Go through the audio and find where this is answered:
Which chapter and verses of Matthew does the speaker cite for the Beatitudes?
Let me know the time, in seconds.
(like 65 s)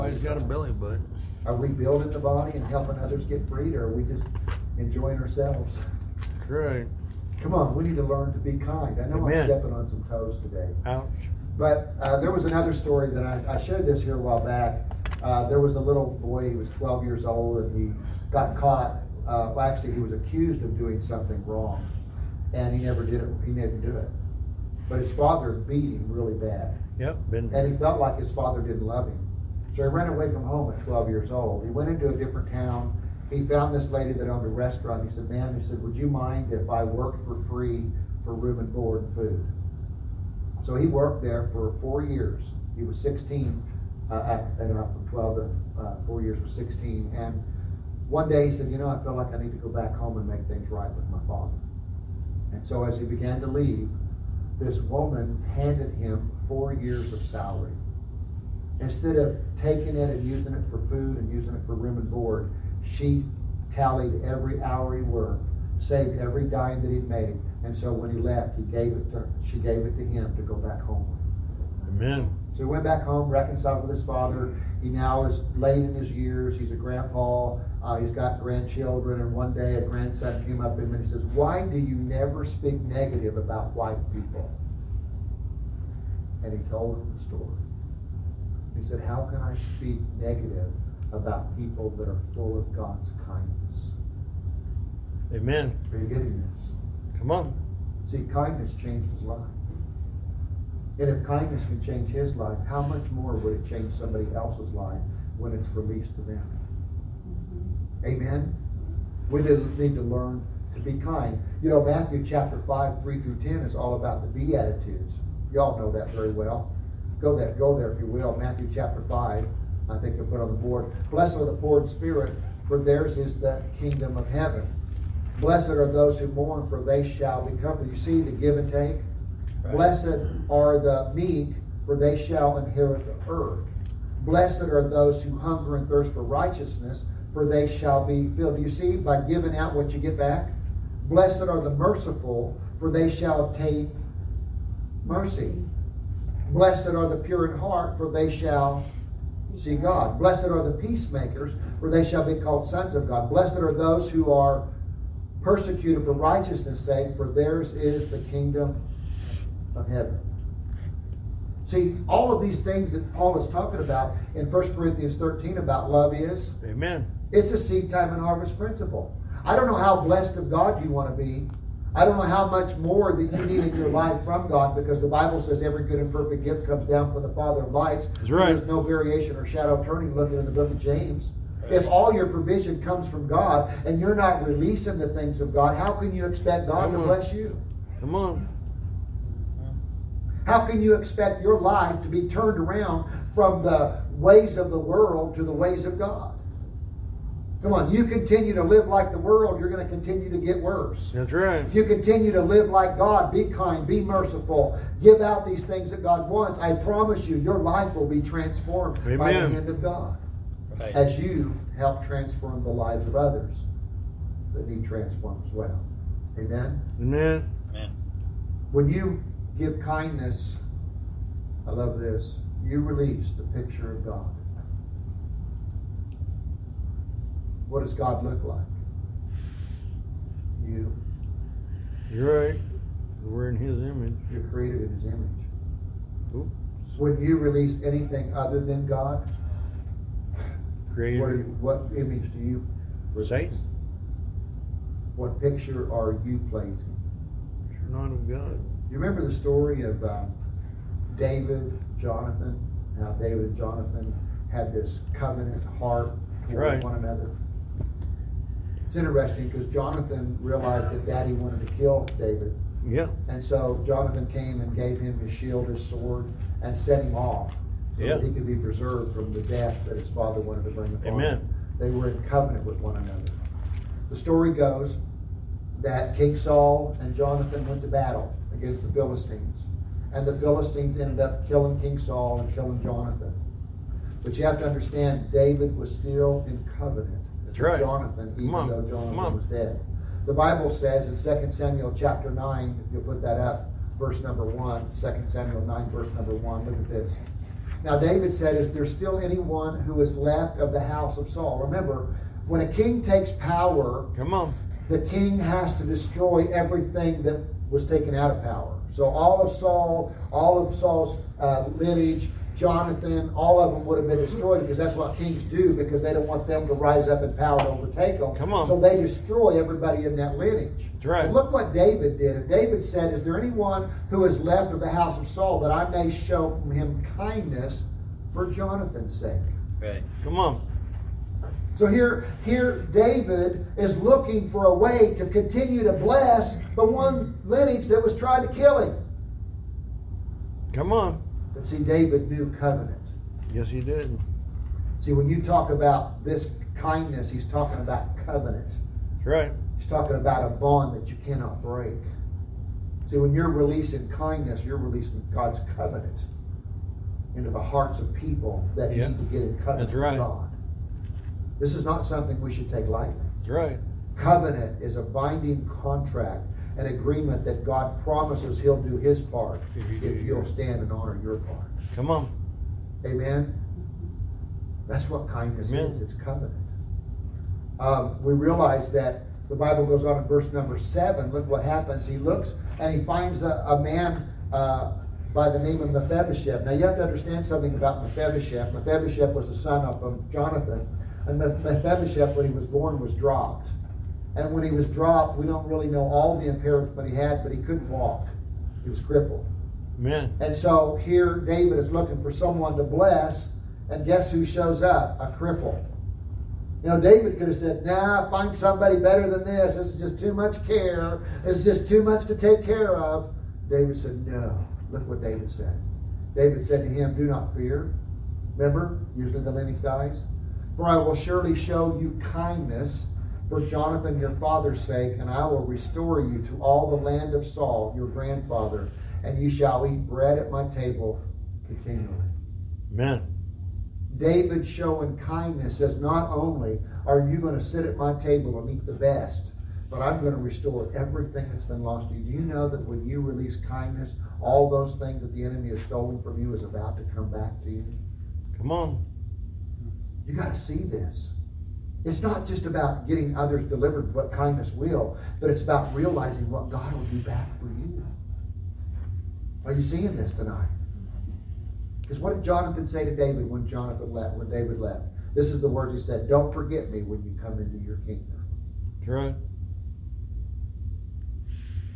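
111 s.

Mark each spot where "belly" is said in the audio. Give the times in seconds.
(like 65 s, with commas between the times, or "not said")
0 s.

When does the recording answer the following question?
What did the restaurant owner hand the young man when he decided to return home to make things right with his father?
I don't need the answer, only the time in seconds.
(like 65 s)
56 s.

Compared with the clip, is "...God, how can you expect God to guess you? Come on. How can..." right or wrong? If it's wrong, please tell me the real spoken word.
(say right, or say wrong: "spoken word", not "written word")
wrong: "bless", not "guess".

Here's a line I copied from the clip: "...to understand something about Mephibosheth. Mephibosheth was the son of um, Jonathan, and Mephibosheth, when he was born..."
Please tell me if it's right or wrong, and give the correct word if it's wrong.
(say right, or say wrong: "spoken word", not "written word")
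right.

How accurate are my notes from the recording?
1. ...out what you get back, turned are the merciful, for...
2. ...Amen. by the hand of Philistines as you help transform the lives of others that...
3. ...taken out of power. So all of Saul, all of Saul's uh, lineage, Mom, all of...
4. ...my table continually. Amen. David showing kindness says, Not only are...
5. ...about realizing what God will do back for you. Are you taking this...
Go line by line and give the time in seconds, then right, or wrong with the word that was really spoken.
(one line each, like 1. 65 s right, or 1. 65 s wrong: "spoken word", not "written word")
1. 139 s wrong: "blessed", not "turned"
2. 209 s wrong: "God", not "Philistines"
3. 307 s wrong: "Jonathan", not "Mom"
4. 430 s right
5. 455 s wrong: "seeing", not "taking".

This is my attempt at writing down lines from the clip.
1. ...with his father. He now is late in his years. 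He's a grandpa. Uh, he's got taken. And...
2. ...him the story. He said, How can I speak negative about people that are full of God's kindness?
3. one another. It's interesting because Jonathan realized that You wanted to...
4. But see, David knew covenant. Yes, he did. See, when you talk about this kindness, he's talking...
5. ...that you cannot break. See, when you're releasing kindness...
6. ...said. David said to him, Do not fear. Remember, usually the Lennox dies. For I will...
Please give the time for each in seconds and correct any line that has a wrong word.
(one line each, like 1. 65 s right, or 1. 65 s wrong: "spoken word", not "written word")
1. 73 s wrong: "grandchildren", not "taken"
2. 86 s right
3. 256 s wrong: "Daddy", not "You"
4. 341 s right
5. 350 s right
6. 415 s right.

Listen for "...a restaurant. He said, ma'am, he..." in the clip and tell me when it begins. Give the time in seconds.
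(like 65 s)
34 s.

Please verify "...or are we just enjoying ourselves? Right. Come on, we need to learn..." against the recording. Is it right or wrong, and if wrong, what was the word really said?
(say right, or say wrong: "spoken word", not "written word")
right.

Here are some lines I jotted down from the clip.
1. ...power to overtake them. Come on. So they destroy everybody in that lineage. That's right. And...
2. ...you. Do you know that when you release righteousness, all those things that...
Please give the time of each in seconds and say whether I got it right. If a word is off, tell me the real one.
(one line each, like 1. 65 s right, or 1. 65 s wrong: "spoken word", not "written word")
1. 317 s right
2. 442 s wrong: "kindness", not "righteousness".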